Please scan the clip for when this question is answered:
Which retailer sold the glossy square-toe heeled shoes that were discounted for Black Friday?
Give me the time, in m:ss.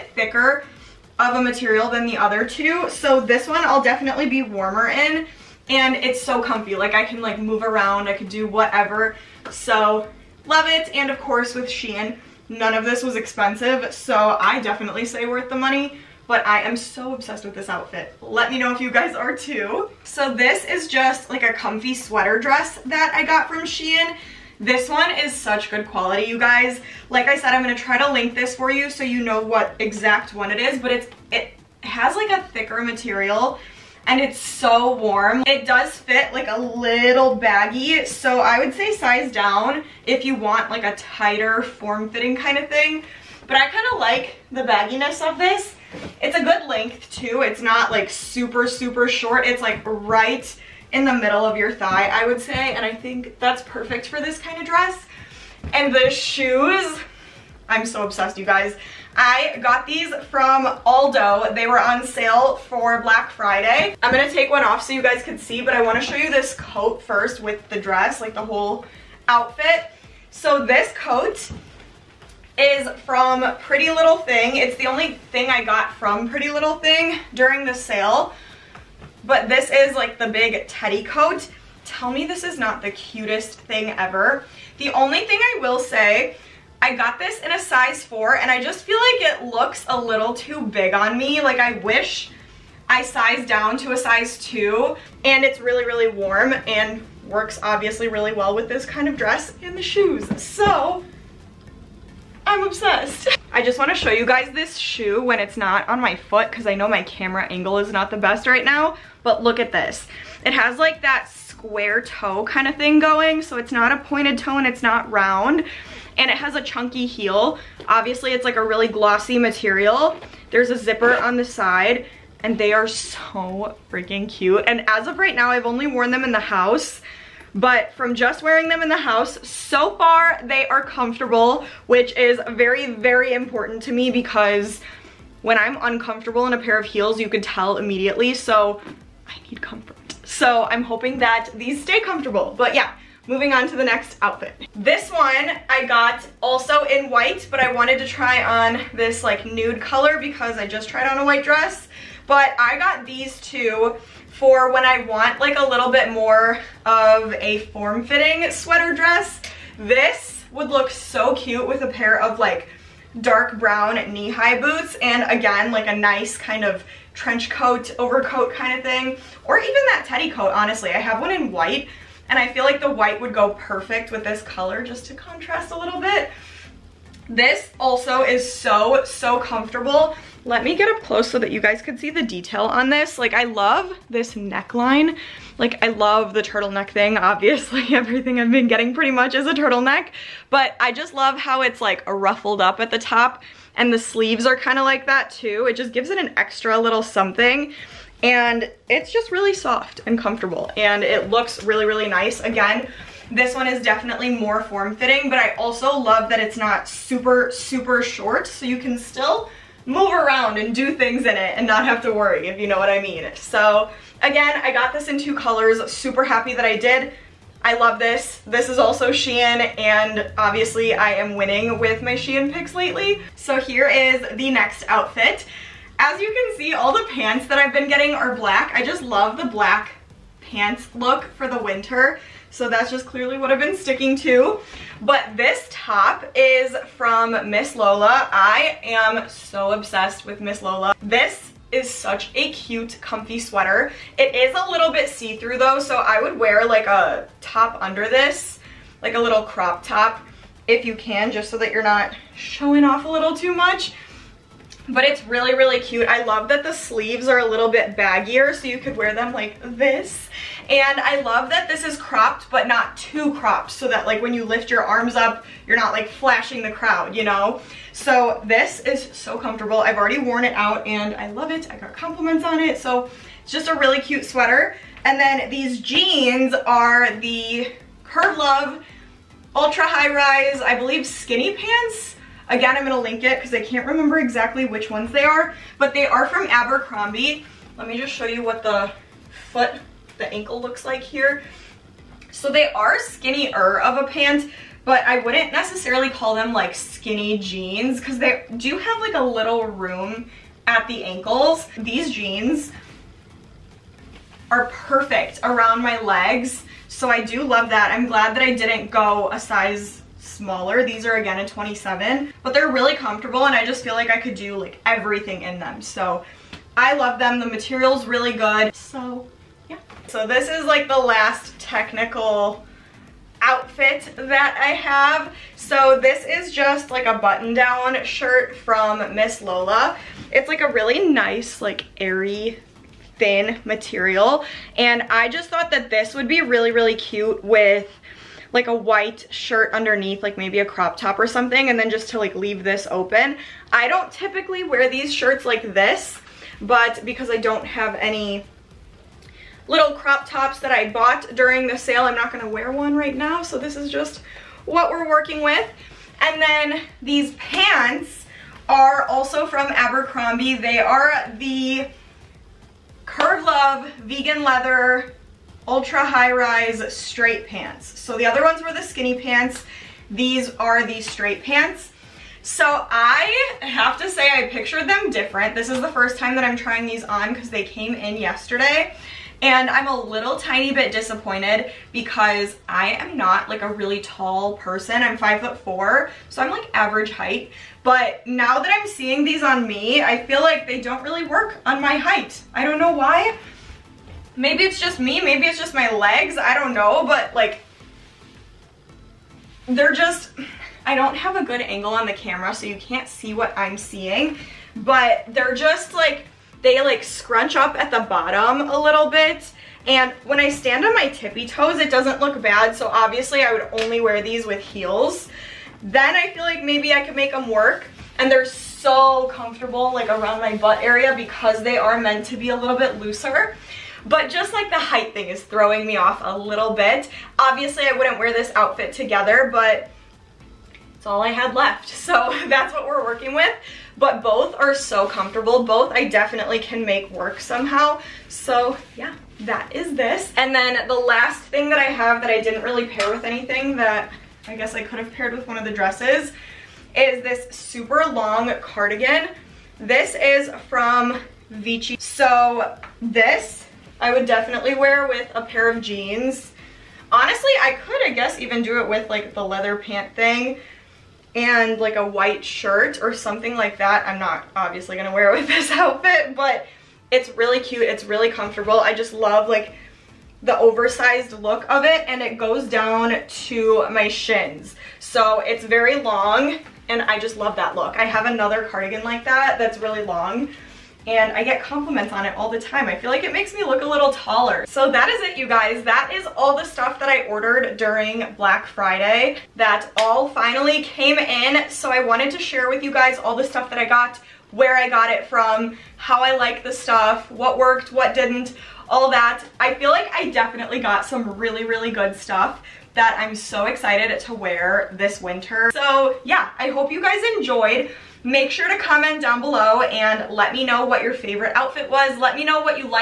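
1:00.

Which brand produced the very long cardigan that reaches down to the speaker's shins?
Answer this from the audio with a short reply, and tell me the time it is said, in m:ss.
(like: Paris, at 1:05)
Vici, at 7:31.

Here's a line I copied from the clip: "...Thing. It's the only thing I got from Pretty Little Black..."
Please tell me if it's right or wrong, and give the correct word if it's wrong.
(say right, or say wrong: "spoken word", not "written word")
wrong: "Thing", not "Black".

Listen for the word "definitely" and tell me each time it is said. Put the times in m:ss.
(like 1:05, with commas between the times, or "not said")
0:03, 0:14, 3:23, 7:16, 7:34, 8:20.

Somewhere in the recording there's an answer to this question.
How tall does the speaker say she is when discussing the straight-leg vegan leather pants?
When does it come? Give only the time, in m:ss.
6:25.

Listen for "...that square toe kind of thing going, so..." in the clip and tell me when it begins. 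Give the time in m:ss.
1:51.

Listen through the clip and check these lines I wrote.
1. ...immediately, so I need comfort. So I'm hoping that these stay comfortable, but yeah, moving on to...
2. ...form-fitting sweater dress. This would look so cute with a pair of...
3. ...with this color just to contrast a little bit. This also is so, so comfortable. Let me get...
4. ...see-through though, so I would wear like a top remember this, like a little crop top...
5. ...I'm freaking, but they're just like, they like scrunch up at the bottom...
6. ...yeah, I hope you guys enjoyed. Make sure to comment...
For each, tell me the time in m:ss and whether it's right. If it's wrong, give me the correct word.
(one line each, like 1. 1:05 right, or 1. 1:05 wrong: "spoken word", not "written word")
1. 2:17 right
2. 2:37 right
3. 2:54 right
4. 4:05 wrong: "under", not "remember"
5. 6:43 wrong: "seeing", not "freaking"
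6. 8:26 right.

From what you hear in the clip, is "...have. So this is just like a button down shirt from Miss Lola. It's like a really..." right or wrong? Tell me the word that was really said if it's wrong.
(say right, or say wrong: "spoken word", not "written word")
right.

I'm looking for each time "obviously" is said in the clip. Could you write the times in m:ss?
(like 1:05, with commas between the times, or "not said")
1:37, 1:57, 3:07, 3:40, 6:52, 7:07, 7:44.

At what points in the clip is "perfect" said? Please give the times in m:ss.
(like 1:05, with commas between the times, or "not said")
0:53, 2:53, 5:04.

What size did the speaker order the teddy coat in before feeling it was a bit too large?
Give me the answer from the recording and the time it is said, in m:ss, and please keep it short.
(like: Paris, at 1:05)
4, at 1:27.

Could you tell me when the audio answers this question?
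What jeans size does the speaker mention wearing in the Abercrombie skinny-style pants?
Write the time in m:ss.
5:11.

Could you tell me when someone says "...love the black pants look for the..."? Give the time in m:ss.
3:49.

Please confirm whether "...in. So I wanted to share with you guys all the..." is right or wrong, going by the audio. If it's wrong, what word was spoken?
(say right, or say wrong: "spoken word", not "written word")
right.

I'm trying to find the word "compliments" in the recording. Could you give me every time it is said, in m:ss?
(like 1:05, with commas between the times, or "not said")
4:31, 8:01.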